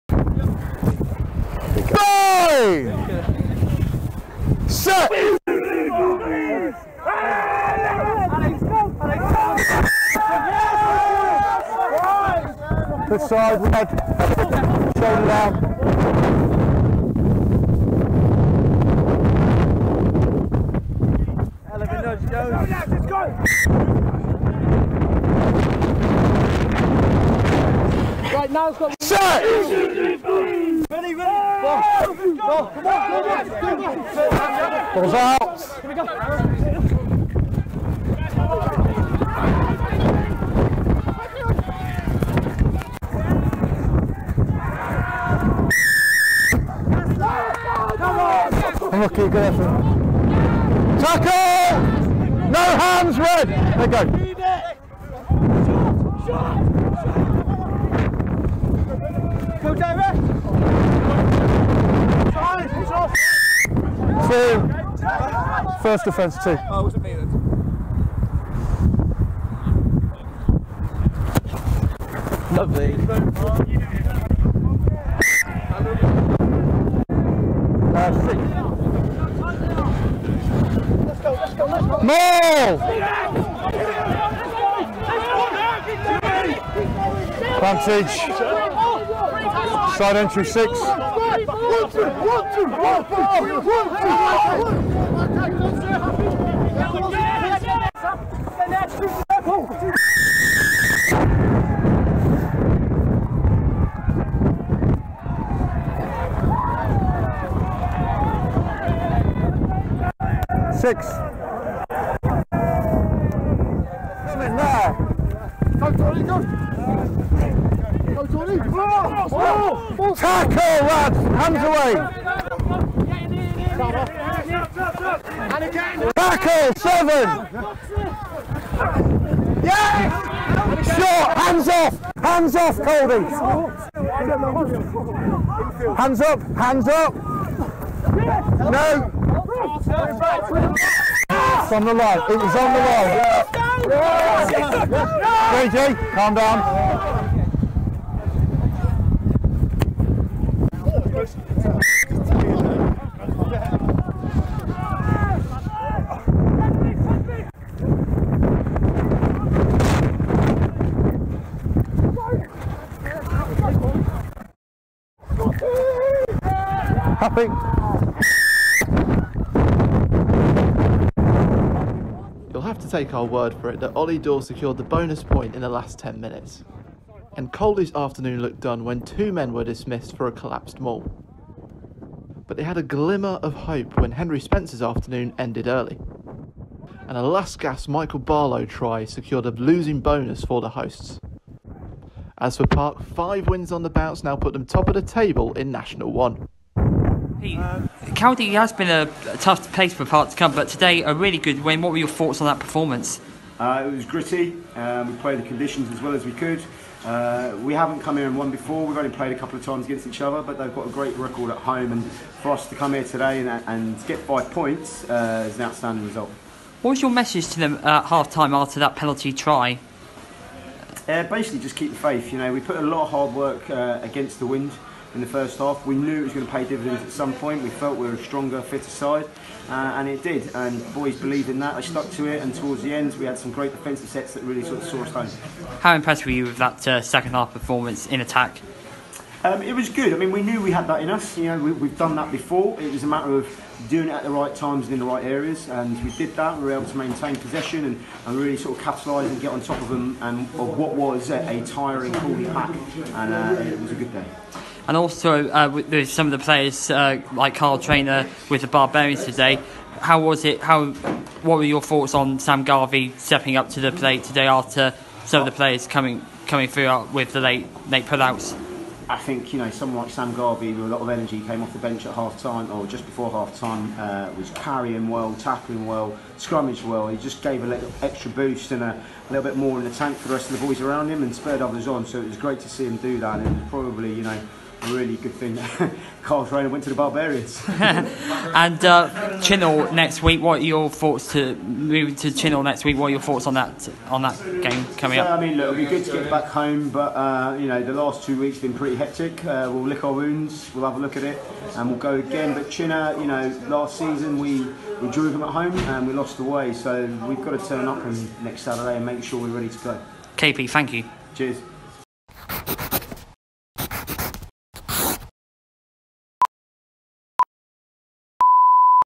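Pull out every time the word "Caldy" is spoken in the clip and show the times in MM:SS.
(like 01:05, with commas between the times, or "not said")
02:57, 03:18.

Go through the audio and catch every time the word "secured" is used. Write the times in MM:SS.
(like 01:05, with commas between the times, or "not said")
02:54, 03:09.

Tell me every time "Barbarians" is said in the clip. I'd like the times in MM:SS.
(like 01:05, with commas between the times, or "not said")
04:18, 04:46.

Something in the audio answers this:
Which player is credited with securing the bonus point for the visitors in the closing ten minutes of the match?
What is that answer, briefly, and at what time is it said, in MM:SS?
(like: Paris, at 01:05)
Ollie Dawe, at 02:53.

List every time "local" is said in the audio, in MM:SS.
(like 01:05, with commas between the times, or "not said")
not said.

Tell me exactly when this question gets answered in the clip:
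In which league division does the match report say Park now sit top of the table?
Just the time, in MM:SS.
03:15.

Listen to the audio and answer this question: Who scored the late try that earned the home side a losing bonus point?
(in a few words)
Michael Barlow.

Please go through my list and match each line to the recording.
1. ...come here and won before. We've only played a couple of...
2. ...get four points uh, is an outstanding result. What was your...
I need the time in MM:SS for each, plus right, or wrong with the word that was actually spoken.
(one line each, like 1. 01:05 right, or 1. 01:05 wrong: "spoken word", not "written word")
1. 03:27 right
2. 03:34 wrong: "five", not "four".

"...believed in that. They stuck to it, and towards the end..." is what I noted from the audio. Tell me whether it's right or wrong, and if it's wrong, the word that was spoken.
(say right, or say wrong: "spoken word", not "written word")
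right.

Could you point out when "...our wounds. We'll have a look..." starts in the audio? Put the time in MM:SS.
05:00.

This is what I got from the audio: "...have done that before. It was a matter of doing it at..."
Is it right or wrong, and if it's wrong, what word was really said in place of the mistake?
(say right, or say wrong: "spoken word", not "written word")
right.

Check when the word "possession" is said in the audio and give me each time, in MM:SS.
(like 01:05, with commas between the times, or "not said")
04:07.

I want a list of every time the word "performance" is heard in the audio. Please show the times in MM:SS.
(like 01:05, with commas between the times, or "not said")
03:22, 03:57.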